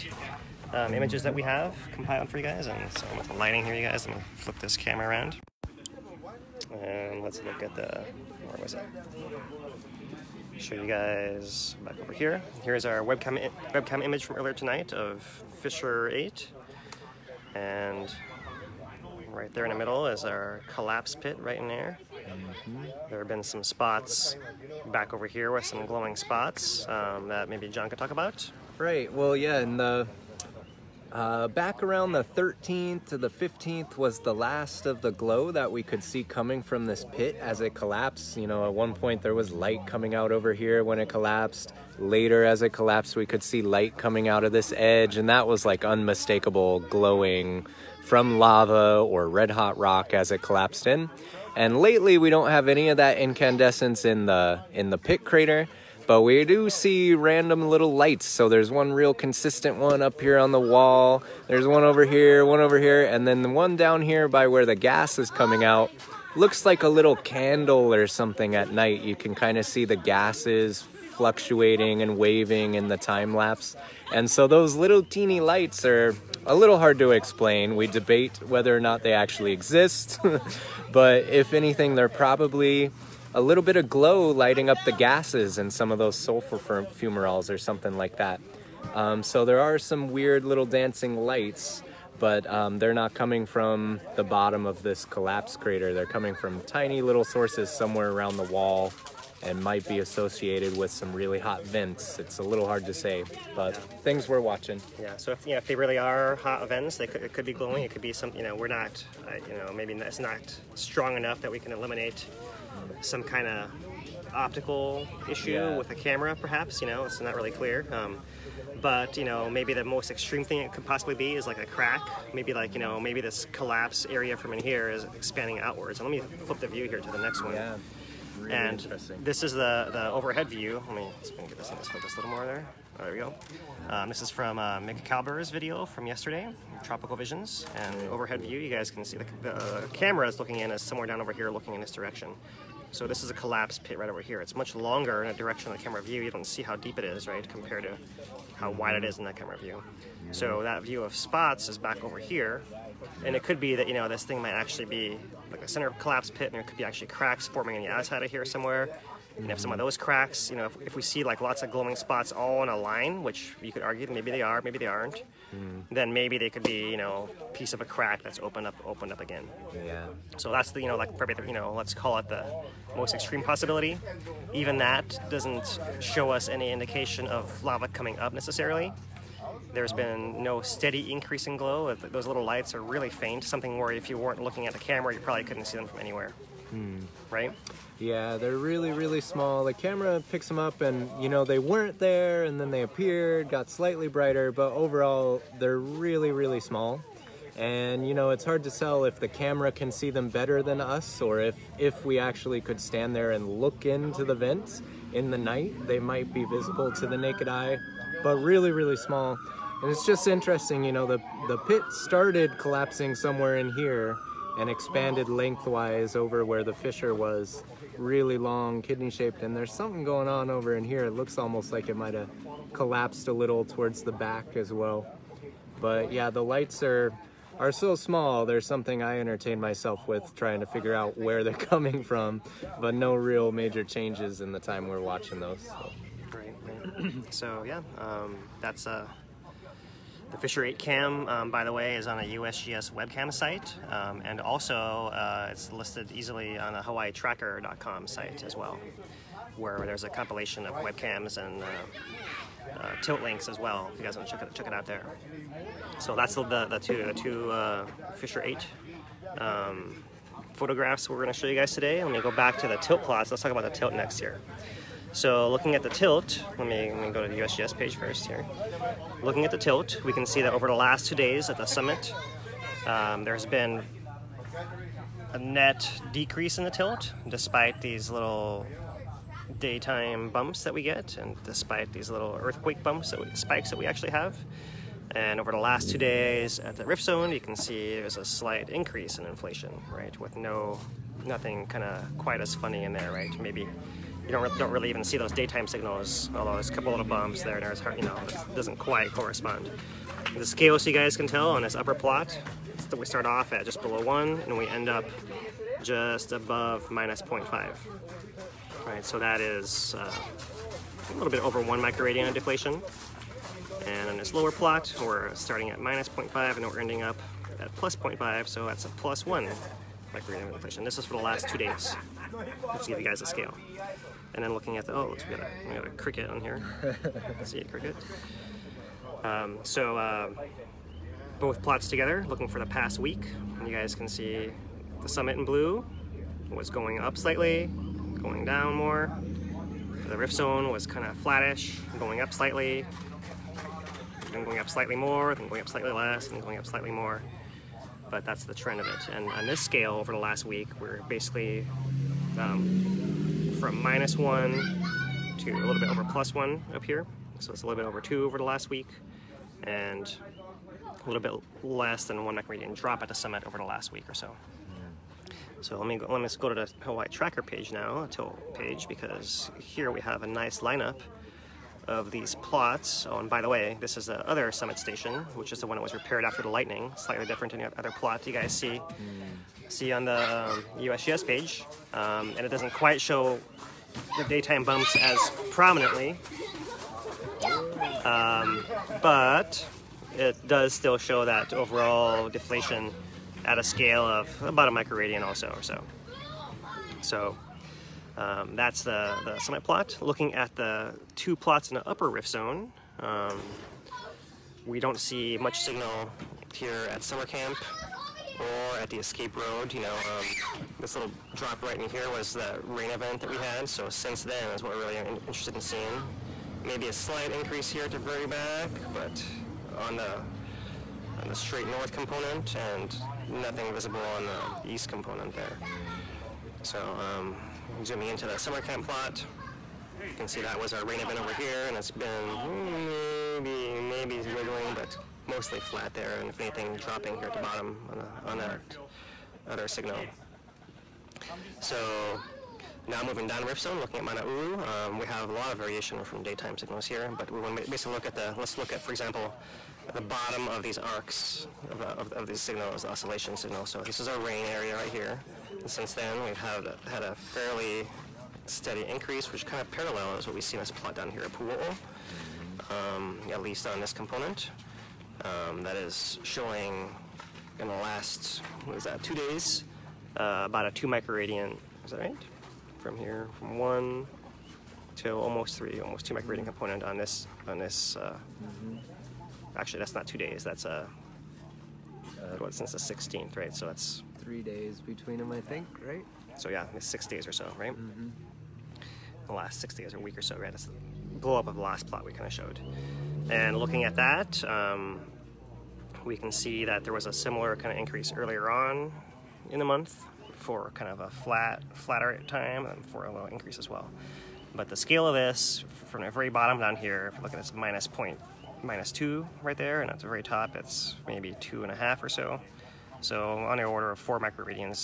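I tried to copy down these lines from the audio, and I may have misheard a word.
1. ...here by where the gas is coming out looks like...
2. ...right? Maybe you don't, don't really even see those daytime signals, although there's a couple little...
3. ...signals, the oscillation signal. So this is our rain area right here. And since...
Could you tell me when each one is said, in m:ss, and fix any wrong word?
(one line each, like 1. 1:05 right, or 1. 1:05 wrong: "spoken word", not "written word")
1. 1:04 right
2. 4:53 right
3. 7:32 right.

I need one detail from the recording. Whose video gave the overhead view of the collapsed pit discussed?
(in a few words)
Mick Kalber.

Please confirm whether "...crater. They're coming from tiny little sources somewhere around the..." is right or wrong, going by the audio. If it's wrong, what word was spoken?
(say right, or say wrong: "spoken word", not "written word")
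right.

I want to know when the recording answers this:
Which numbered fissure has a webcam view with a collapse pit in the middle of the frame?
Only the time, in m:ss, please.
0:15.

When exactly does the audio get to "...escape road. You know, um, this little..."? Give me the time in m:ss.
6:48.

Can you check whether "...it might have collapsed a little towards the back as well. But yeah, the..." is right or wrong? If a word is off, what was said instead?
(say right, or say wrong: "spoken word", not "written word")
right.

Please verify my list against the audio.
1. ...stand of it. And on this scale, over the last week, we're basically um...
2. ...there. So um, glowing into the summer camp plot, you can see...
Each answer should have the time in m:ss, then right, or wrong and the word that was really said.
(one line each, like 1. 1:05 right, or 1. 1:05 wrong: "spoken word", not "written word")
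1. 5:48 wrong: "trend", not "stand"
2. 7:05 wrong: "zooming", not "glowing".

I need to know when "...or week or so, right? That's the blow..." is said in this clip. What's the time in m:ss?
8:09.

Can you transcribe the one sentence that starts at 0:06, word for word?
And let's look at the, where was it?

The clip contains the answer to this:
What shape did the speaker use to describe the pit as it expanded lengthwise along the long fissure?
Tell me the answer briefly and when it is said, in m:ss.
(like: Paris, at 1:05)
kidney shaped, at 3:38.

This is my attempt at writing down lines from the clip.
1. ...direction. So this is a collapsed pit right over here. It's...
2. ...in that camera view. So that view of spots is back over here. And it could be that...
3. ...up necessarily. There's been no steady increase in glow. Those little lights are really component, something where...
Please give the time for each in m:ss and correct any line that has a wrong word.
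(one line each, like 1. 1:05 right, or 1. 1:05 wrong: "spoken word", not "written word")
1. 2:21 right
2. 2:29 right
3. 2:58 wrong: "faint", not "component".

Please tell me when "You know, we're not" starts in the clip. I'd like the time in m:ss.
1:48.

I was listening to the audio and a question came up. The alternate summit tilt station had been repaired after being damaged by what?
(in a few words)
lightning.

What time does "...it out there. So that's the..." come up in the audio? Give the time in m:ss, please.
4:14.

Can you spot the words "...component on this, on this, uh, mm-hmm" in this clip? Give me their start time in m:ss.
7:56.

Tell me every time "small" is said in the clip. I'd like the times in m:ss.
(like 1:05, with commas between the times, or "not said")
3:09, 3:16, 3:28, 3:47.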